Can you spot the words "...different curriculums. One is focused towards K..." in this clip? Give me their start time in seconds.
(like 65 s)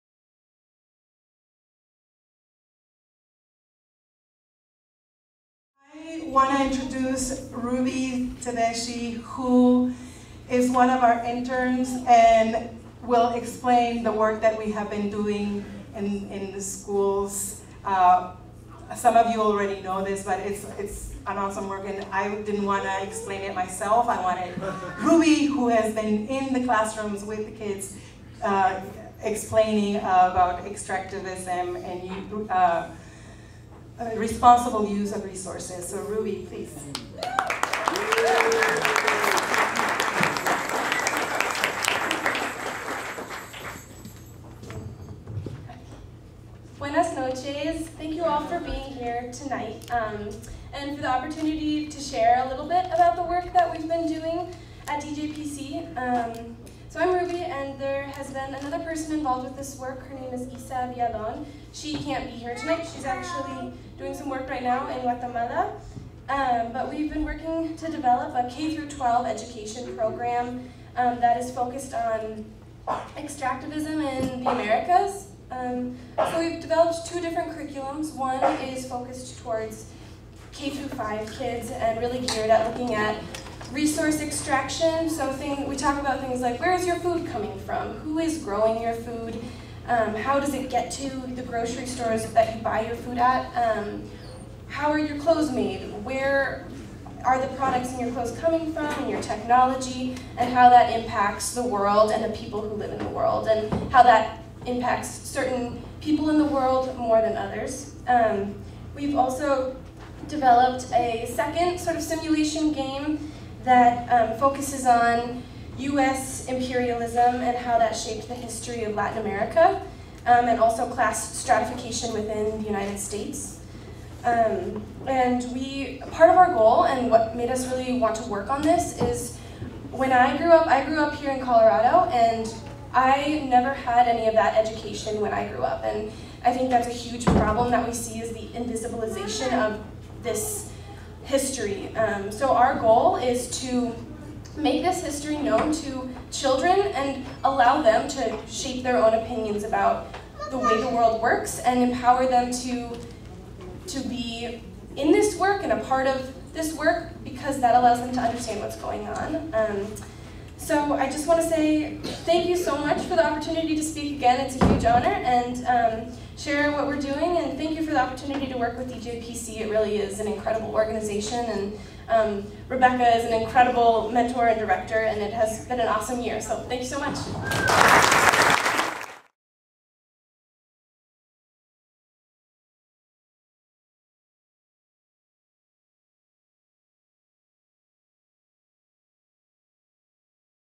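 77 s.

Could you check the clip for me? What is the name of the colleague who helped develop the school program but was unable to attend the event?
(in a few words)
Isa Villalon.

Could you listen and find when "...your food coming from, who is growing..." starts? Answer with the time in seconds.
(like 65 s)
86 s.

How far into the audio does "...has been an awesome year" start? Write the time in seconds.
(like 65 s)
175 s.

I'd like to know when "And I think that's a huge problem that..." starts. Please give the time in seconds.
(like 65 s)
135 s.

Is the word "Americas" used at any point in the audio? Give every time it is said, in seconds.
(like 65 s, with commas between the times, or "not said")
74 s, 119 s.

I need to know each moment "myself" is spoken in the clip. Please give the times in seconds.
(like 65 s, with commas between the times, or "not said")
23 s.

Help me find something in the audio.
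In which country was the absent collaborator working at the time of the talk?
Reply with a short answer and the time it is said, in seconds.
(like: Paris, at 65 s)
Guatemala, at 65 s.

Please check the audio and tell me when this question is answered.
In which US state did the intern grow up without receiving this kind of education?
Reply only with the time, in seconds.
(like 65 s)
131 s.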